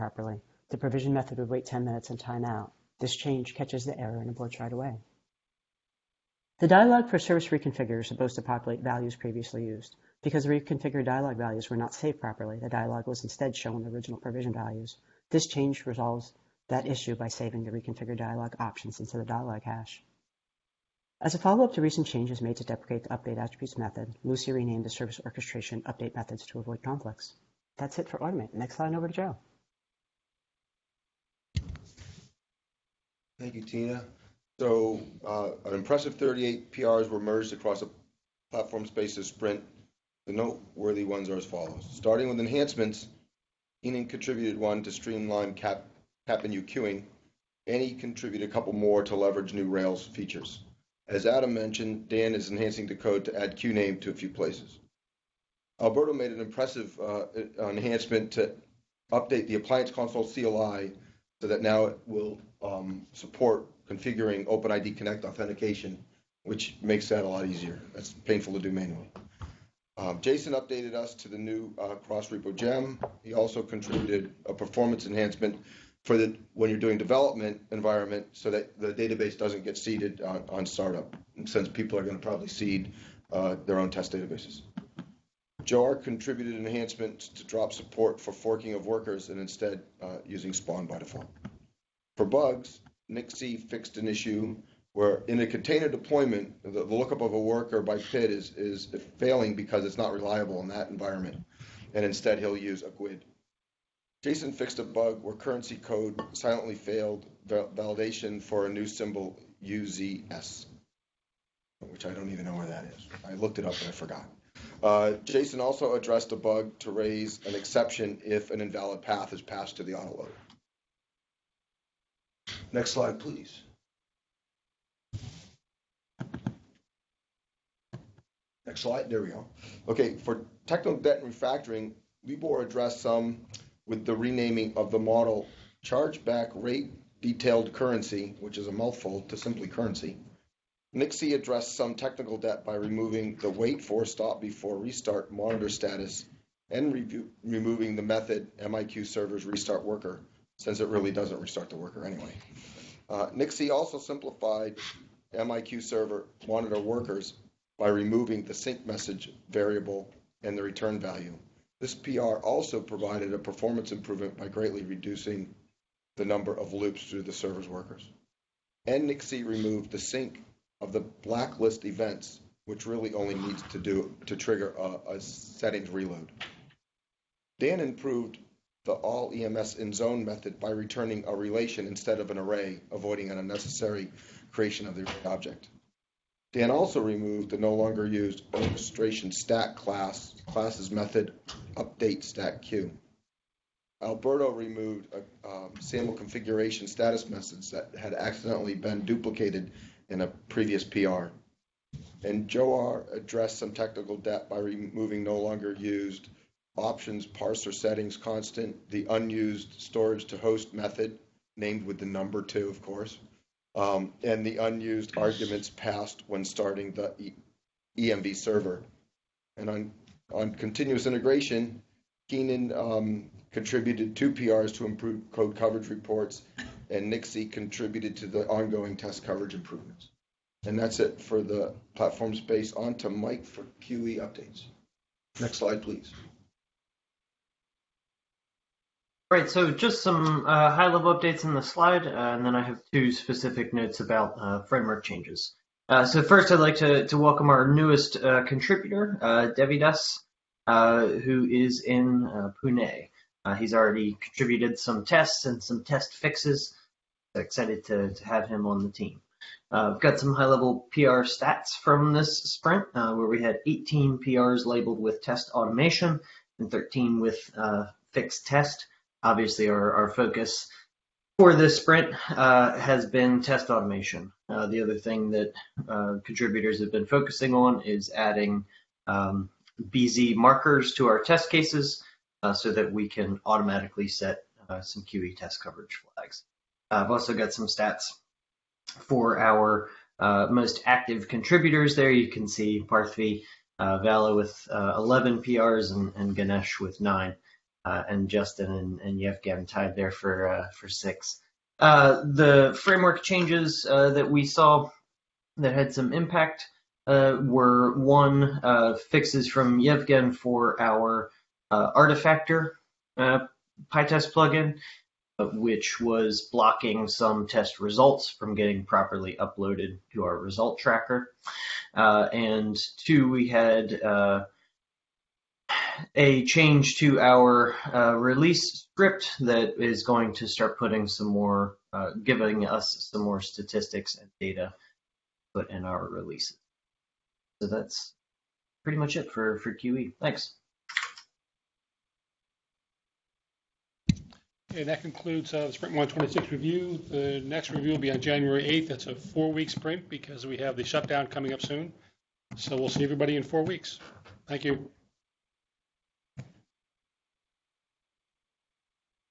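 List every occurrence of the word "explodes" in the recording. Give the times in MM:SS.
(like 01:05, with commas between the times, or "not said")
not said.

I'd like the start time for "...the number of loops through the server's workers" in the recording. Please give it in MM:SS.
02:46.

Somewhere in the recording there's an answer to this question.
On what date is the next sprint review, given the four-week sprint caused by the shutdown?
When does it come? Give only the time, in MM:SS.
05:48.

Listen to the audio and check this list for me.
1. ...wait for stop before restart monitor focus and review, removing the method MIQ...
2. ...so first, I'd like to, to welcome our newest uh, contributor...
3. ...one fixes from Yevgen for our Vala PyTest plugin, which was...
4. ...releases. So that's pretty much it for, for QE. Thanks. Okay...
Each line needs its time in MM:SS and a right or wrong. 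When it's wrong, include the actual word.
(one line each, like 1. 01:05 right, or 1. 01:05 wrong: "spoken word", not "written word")
1. 02:23 wrong: "status", not "focus"
2. 04:06 right
3. 05:07 wrong: "Artifactor", not "Vala"
4. 05:36 right.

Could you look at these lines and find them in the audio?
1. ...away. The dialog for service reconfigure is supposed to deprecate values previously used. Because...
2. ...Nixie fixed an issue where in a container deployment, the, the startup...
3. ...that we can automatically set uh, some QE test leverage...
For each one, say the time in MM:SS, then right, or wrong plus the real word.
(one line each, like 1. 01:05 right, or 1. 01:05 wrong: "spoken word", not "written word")
1. 00:04 wrong: "populate", not "deprecate"
2. 01:33 wrong: "lookup", not "startup"
3. 04:42 wrong: "coverage", not "leverage".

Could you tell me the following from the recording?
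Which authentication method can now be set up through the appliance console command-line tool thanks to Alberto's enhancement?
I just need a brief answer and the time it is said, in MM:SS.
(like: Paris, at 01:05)
OpenID Connect, at 01:04.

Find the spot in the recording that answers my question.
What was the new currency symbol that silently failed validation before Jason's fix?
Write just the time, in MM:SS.
01:49.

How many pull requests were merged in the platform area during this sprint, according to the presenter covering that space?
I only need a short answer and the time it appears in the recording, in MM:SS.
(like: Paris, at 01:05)
38, at 00:36.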